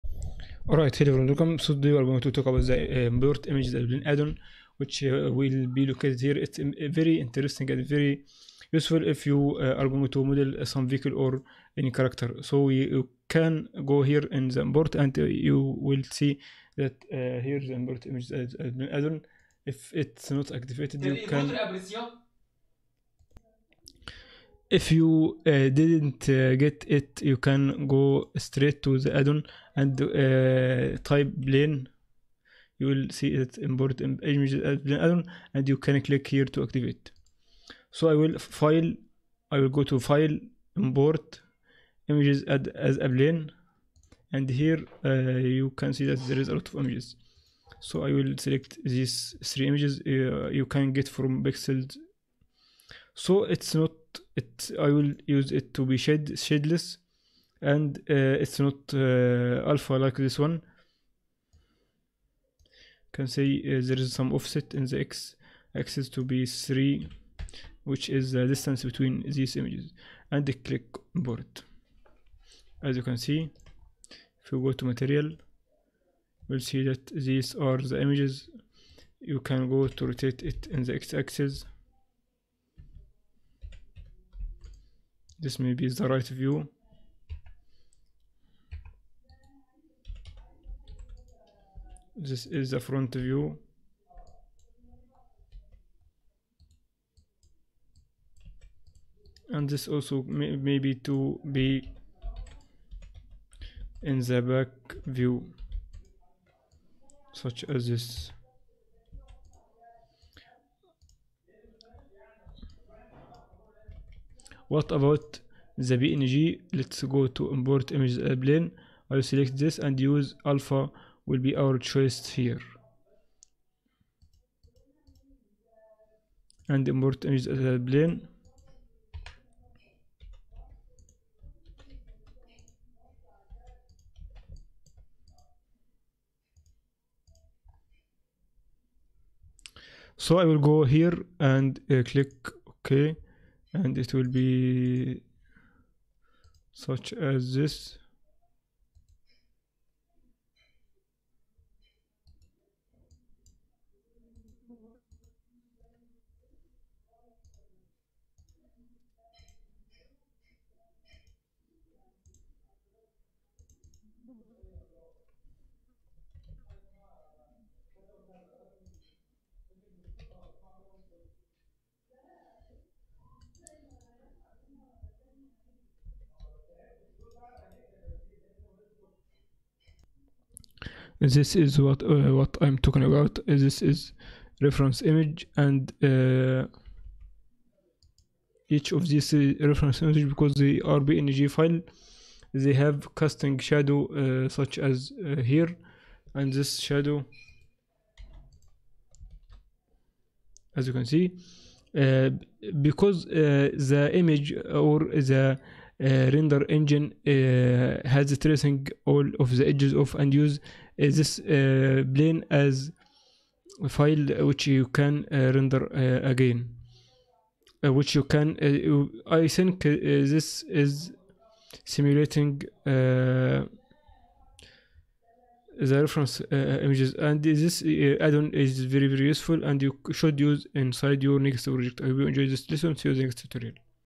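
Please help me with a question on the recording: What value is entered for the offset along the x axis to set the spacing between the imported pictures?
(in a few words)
3.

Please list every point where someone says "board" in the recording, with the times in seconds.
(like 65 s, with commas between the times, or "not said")
71 s.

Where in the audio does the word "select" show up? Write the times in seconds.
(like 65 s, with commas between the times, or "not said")
48 s, 119 s.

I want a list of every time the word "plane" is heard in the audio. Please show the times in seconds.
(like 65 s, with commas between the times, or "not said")
31 s, 43 s, 118 s, 127 s, 212 s.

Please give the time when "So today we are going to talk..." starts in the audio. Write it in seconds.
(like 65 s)
1 s.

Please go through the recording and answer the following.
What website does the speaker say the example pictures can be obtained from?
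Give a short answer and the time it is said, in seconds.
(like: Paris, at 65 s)
Pixels, at 51 s.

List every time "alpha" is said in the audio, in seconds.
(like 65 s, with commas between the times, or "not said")
59 s, 120 s.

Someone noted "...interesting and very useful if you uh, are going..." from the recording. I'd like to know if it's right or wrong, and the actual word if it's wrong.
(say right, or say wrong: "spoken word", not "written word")
right.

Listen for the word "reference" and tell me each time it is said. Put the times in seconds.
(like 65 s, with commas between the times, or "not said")
184 s, 189 s, 225 s.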